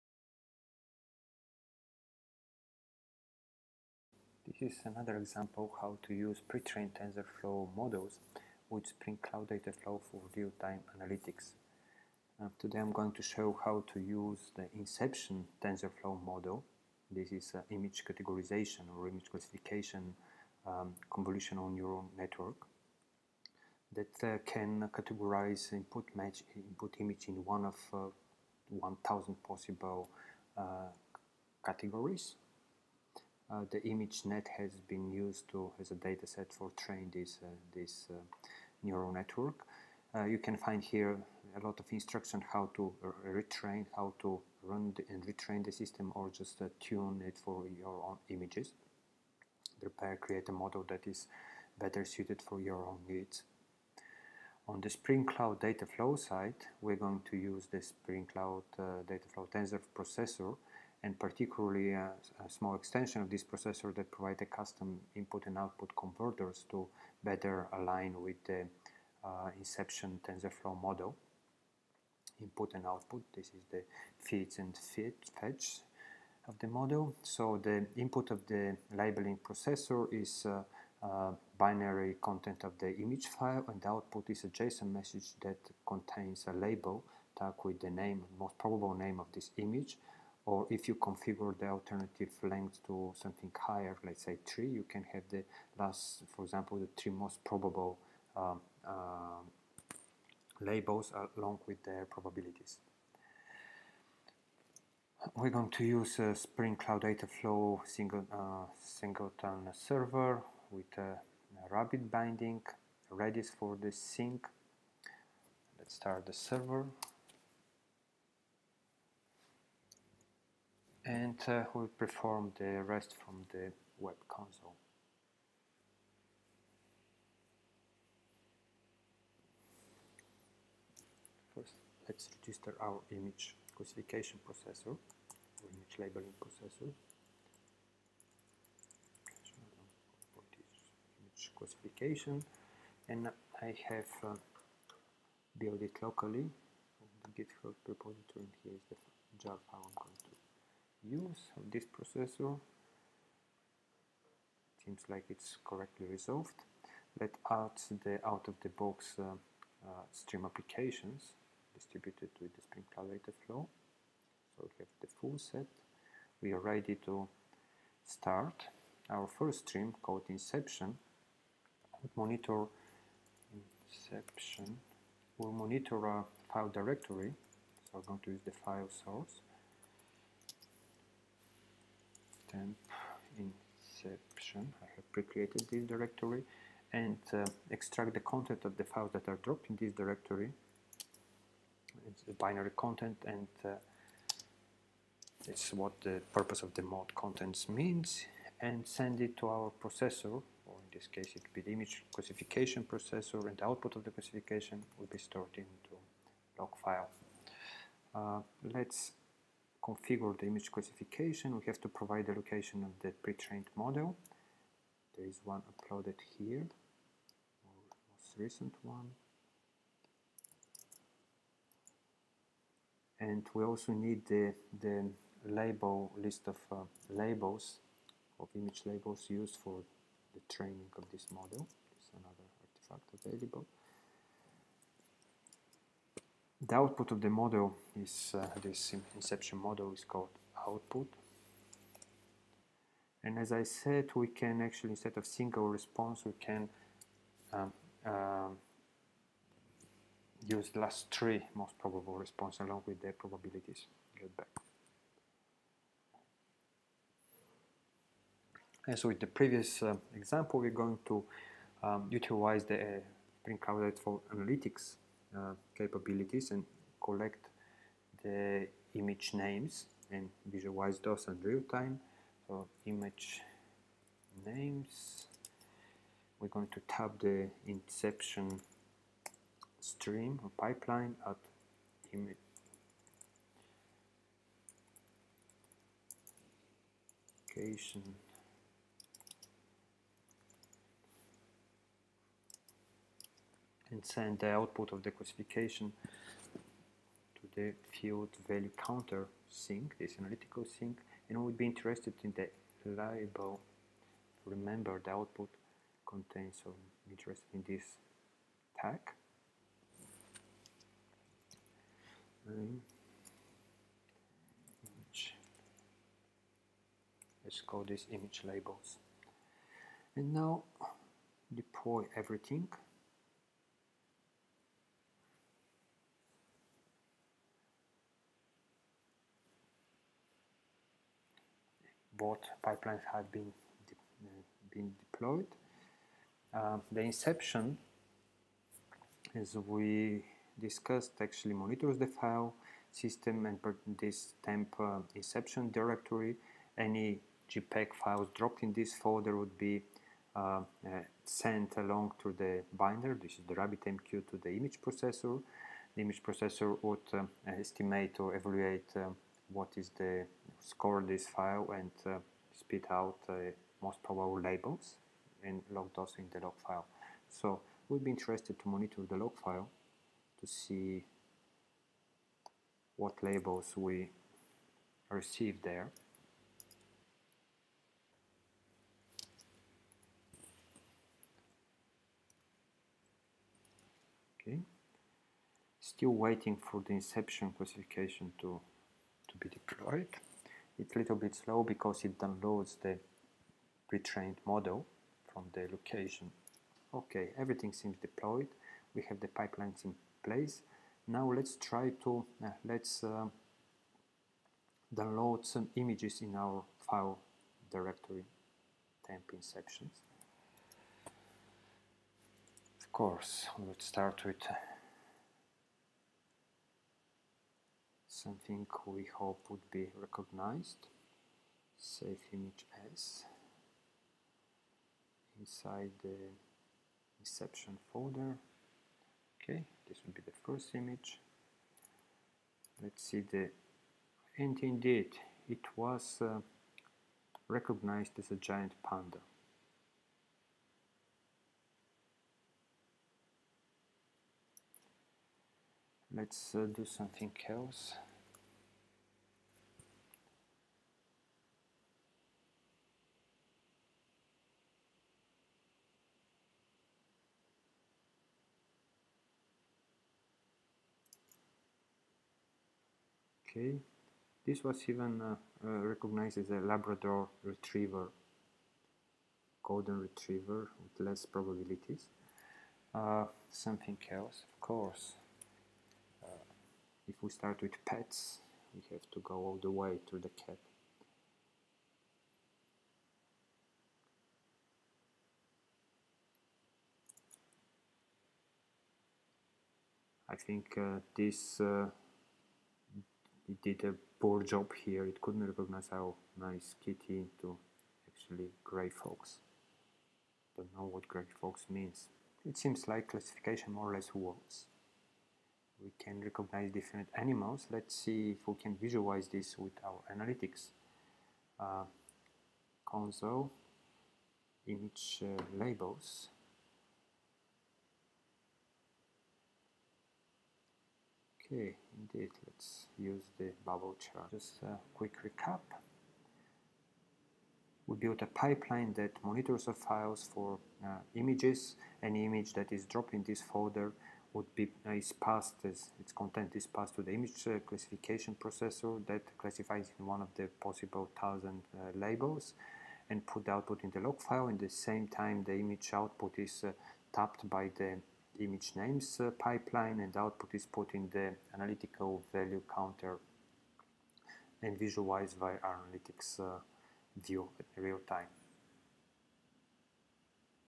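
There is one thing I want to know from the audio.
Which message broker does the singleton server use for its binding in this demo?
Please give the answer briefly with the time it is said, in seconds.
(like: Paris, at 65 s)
RabbitMQ, at 111 s.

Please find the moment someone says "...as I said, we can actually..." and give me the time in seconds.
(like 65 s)
243 s.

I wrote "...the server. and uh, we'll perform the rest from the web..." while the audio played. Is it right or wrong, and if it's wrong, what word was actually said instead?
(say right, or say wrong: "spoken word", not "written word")
right.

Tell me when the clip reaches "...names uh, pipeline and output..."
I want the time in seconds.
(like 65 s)
548 s.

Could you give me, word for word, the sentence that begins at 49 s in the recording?
Prepare, create a model that is better suited for your own needs.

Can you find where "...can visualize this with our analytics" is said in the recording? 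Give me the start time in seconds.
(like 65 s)
508 s.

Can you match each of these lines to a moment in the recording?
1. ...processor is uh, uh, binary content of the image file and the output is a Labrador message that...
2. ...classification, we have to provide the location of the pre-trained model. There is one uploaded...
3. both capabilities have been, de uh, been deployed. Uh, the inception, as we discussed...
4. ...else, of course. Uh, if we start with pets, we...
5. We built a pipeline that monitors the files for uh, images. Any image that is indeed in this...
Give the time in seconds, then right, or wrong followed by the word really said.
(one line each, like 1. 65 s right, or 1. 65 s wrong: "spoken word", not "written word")
1. 79 s wrong: "JSON", not "Labrador"
2. 210 s right
3. 332 s wrong: "pipelines", not "capabilities"
4. 474 s right
5. 527 s wrong: "dropped", not "indeed".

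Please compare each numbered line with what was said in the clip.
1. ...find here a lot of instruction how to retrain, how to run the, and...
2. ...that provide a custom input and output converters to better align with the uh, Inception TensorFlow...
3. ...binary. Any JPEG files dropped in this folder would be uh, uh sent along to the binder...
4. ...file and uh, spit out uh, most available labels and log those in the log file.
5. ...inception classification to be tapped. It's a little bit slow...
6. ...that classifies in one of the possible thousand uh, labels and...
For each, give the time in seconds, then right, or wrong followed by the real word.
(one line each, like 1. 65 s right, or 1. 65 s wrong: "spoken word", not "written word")
1. 40 s right
2. 63 s right
3. 345 s wrong: "directory", not "binary"
4. 361 s wrong: "probable", not "available"
5. 386 s wrong: "deployed", not "tapped"
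6. 539 s right.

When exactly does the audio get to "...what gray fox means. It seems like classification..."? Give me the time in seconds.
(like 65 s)
500 s.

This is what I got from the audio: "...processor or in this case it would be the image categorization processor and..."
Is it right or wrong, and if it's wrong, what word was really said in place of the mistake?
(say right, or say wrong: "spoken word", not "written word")
wrong: "classification", not "categorization".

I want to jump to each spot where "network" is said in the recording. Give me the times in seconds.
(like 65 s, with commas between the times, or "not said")
22 s, 39 s.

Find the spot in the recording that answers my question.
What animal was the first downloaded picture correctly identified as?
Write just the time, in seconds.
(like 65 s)
438 s.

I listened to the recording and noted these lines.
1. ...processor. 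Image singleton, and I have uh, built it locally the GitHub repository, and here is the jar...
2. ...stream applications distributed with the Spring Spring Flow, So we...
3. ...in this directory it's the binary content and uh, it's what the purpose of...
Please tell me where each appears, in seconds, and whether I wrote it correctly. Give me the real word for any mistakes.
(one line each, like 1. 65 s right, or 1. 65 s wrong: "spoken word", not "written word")
1. 136 s wrong: "classification", not "singleton"
2. 160 s wrong: "Cloud", not "Spring"
3. 189 s right.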